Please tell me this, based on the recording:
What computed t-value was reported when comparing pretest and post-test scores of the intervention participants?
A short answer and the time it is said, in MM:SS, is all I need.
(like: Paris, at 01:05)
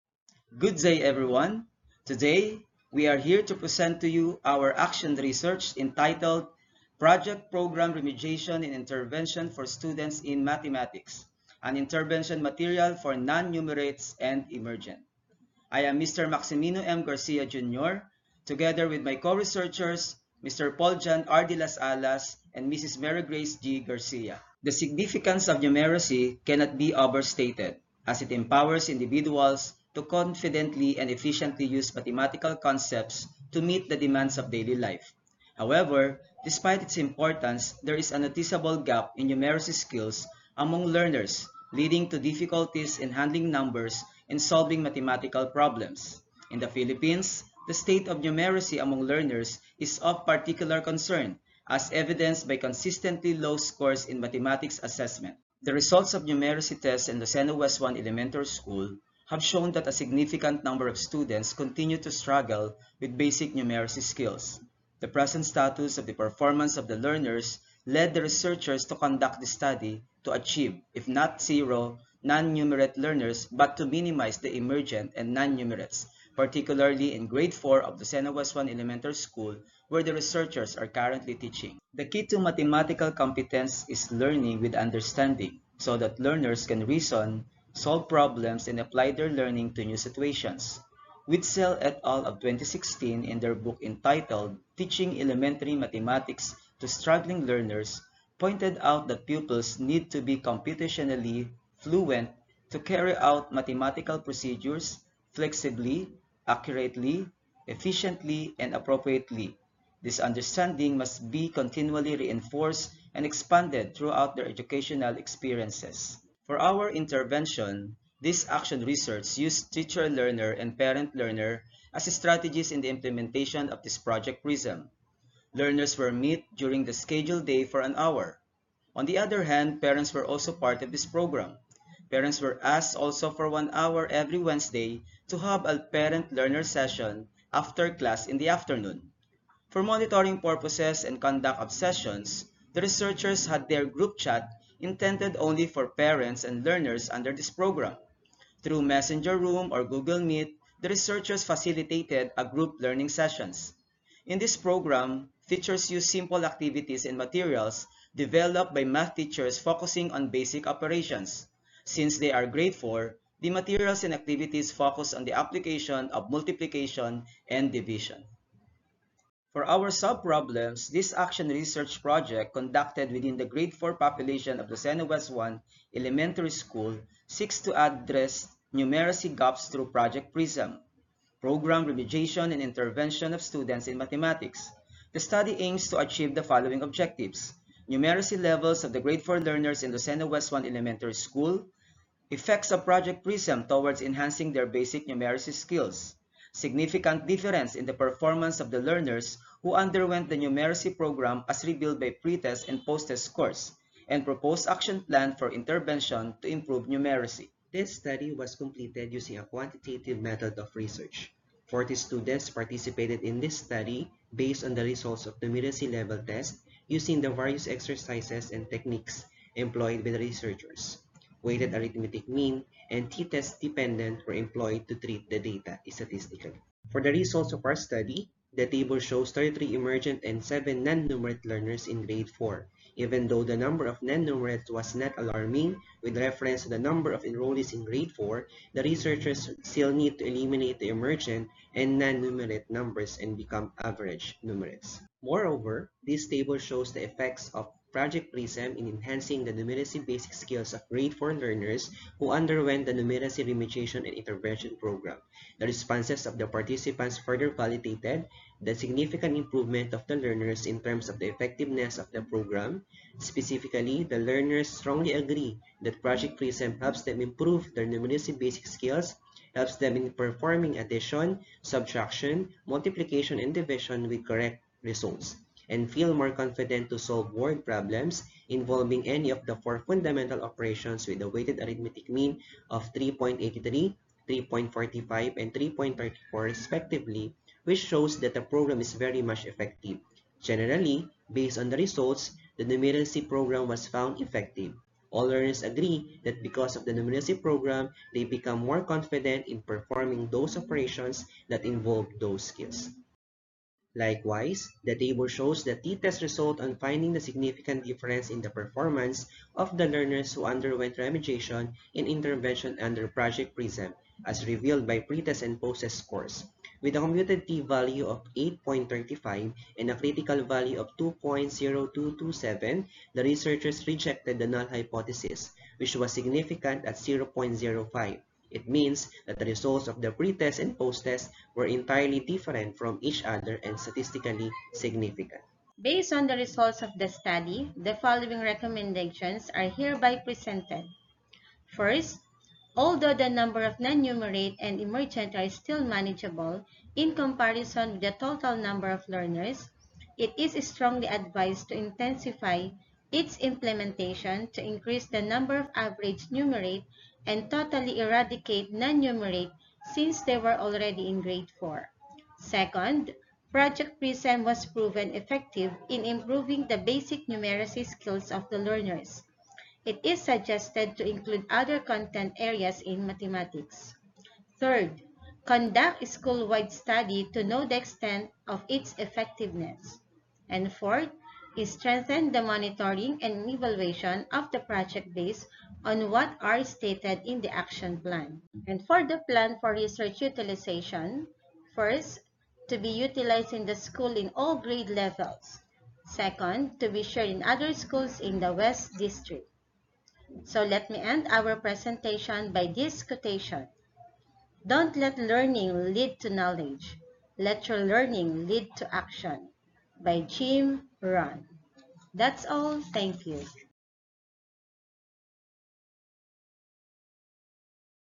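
8.35, at 05:18.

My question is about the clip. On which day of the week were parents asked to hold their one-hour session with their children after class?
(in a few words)
Wednesday.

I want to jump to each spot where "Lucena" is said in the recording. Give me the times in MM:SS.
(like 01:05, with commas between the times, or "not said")
00:57, 01:18, 02:54, 03:09.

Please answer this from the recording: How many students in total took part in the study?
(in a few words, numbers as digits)
40.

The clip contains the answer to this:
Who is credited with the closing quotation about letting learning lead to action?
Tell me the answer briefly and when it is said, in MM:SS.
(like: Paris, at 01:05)
Jim Rohn, at 06:50.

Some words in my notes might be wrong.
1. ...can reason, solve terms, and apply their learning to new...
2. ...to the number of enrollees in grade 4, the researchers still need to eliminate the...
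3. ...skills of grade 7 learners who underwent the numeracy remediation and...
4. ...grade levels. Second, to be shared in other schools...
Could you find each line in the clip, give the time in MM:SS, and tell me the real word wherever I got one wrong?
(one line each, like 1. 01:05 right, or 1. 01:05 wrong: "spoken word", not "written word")
1. 01:26 wrong: "problems", not "terms"
2. 03:56 right
3. 04:10 wrong: "4", not "7"
4. 06:34 right.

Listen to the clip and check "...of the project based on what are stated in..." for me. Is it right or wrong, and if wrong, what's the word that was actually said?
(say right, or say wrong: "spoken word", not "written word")
right.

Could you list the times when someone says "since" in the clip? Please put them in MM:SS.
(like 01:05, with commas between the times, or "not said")
02:41, 05:59.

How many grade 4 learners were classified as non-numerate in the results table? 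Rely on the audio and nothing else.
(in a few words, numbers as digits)
7.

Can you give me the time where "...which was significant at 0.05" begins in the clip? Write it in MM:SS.
05:25.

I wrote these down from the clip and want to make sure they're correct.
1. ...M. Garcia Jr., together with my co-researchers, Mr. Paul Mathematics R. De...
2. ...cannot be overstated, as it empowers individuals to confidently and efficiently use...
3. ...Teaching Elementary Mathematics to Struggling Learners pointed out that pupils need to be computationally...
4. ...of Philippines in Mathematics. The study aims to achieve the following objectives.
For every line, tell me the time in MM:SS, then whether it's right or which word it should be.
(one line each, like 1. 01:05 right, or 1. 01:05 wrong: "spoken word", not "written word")
1. 00:16 wrong: "John", not "Mathematics"
2. 00:26 right
3. 01:34 right
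4. 03:03 wrong: "Students", not "Philippines".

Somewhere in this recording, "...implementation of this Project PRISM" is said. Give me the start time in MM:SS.
02:02.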